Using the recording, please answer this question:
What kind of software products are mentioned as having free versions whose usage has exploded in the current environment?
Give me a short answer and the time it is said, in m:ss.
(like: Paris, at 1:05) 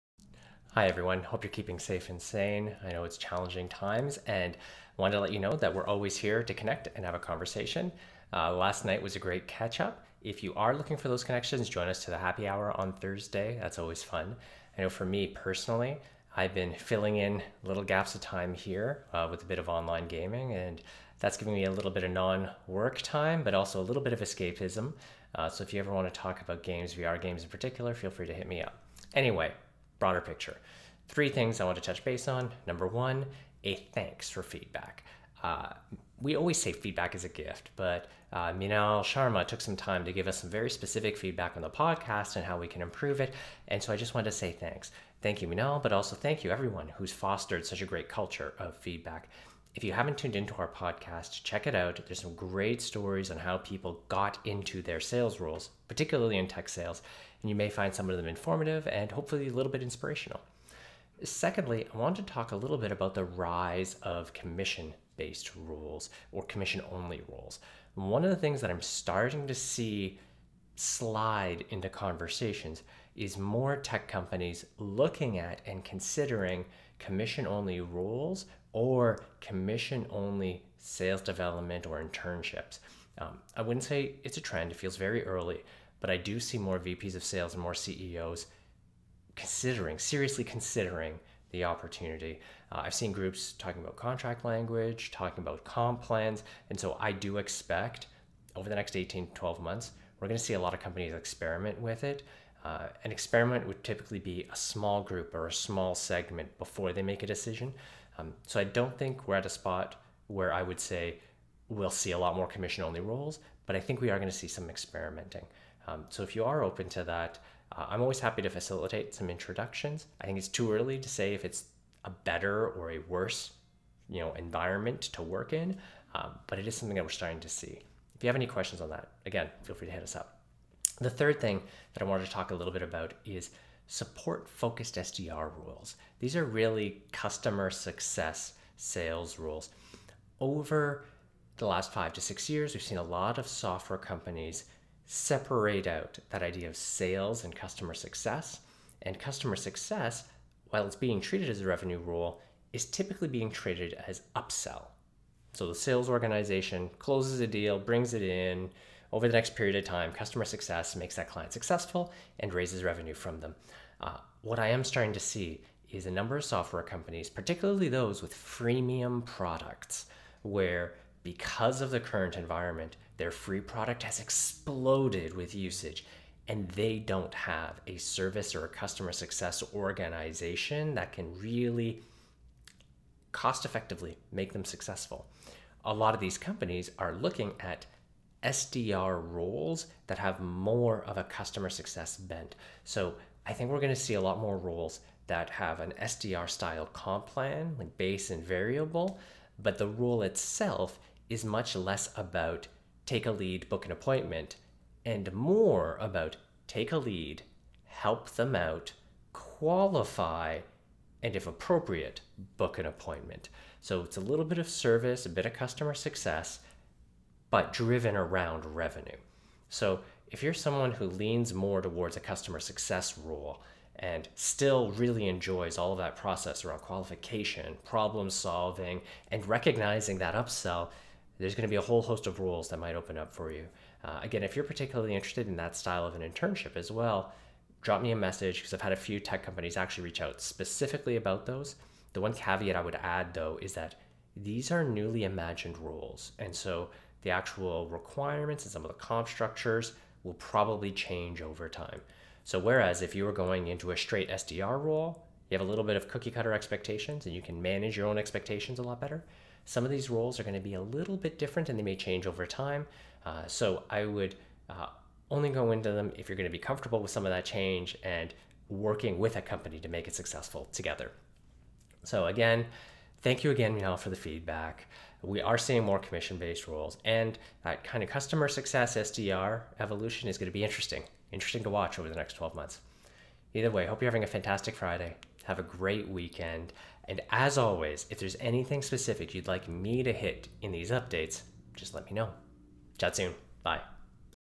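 freemium, at 2:48.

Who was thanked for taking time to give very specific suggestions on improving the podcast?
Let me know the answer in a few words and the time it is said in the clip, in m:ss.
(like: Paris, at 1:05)
Minal Sharma, at 0:38.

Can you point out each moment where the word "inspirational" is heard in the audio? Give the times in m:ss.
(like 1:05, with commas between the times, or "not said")
0:59.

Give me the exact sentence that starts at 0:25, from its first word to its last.
Uh, so if you ever want to talk about games, VR games in particular, feel free to hit me up.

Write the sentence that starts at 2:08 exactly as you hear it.
If you have any questions on that, again, feel free to hit us up.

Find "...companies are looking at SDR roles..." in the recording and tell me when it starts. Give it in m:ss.
3:06.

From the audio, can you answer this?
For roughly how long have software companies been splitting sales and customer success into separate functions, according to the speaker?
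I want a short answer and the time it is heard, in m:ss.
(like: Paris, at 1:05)
5 to 6 years, at 2:21.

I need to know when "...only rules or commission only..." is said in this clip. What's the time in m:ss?
1:17.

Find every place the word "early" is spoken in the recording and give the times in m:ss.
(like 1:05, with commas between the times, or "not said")
1:25, 2:00.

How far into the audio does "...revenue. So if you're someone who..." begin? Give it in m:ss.
3:38.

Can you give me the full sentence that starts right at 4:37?
And that kind of customer success SDR evolution is going to be interesting, interesting to watch over the next 12 months.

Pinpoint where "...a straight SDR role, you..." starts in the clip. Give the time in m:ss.
4:13.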